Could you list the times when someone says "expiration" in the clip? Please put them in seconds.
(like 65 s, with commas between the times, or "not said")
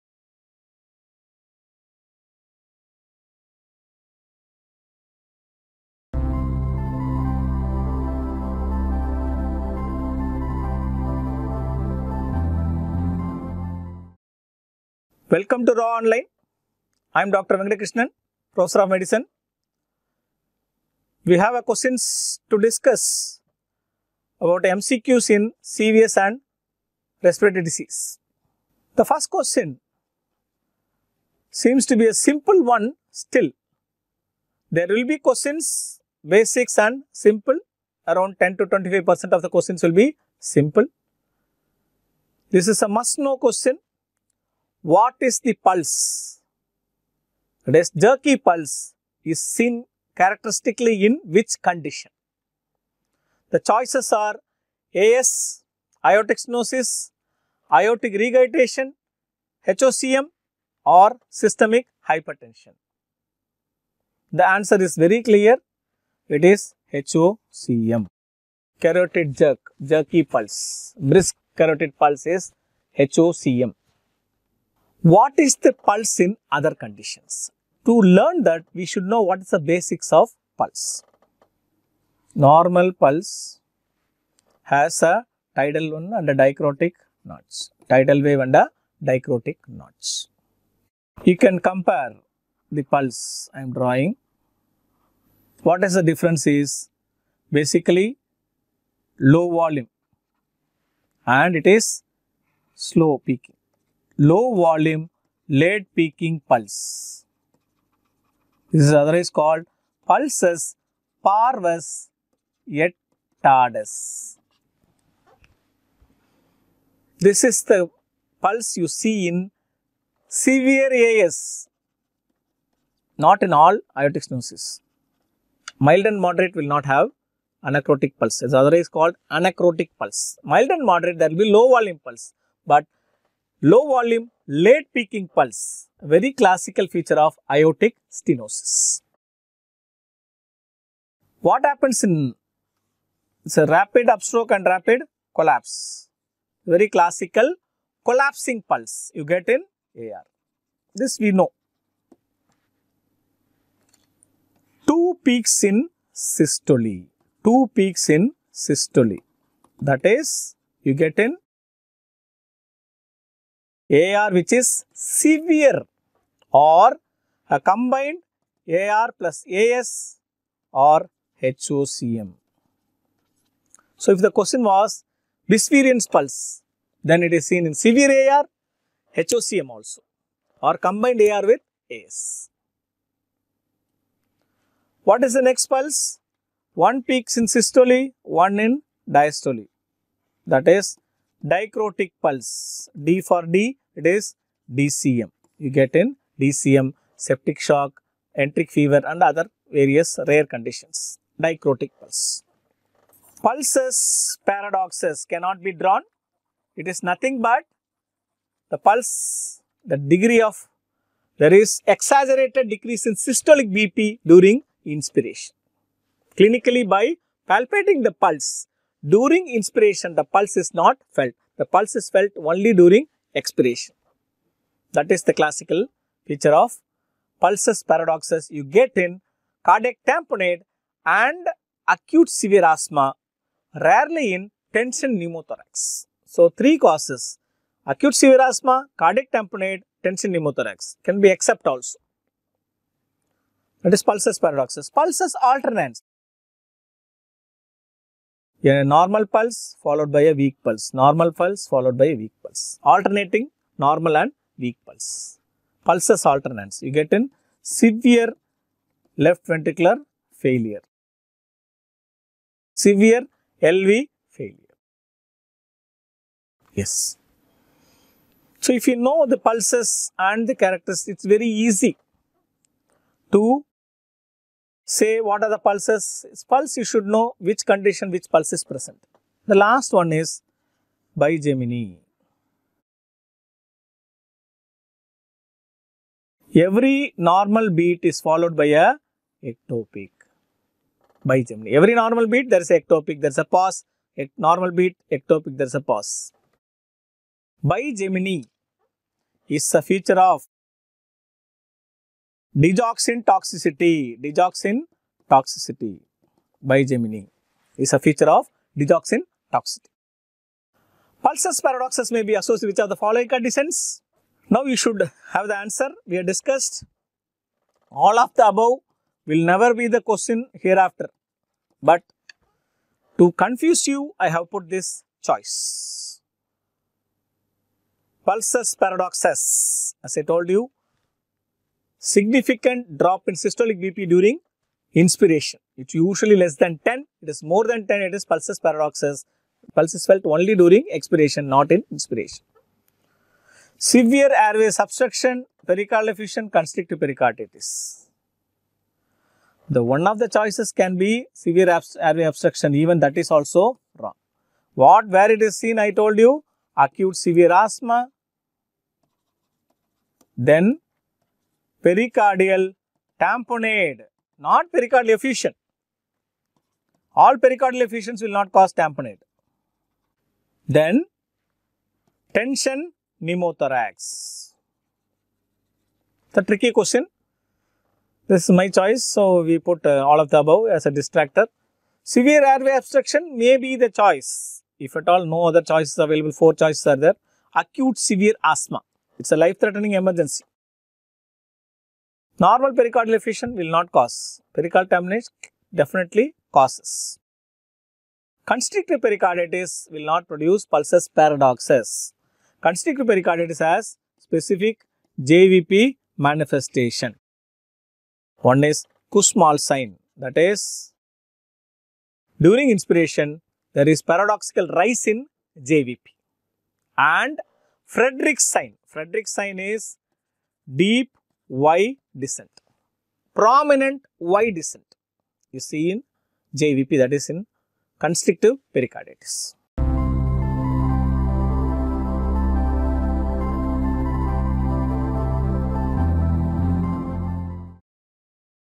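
223 s, 340 s.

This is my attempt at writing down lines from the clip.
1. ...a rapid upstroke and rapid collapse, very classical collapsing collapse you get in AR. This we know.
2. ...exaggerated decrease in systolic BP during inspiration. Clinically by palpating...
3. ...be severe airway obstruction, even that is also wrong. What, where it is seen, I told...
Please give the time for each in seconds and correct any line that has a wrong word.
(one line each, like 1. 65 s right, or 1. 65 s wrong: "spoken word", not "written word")
1. 143 s wrong: "pulse", not "collapse"
2. 211 s right
3. 350 s right.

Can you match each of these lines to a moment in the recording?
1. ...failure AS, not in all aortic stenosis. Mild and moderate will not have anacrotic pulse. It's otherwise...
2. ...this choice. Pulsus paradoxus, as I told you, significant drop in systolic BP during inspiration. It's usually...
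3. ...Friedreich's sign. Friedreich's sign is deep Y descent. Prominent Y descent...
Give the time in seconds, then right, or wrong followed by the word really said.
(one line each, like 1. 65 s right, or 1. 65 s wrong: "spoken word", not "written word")
1. 120 s wrong: "severe", not "failure"
2. 324 s right
3. 417 s right.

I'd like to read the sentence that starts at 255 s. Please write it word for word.
Pulsus alternans, you get in severe left ventricular failure, severe LV failure.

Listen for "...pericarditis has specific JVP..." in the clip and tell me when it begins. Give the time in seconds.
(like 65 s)
403 s.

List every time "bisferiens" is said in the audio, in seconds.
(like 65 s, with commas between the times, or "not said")
175 s.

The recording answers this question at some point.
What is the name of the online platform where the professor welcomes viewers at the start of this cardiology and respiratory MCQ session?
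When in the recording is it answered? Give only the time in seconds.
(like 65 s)
15 s.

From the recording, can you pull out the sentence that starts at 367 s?
All pericardial effusions will not cause tamponade.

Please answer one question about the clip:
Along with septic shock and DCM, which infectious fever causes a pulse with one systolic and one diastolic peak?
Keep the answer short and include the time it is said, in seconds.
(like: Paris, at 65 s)
enteric fever, at 198 s.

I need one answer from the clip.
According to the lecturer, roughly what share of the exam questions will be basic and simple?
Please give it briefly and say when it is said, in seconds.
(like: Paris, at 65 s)
10 to 25 percent, at 38 s.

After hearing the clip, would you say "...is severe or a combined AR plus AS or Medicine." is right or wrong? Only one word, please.
wrong.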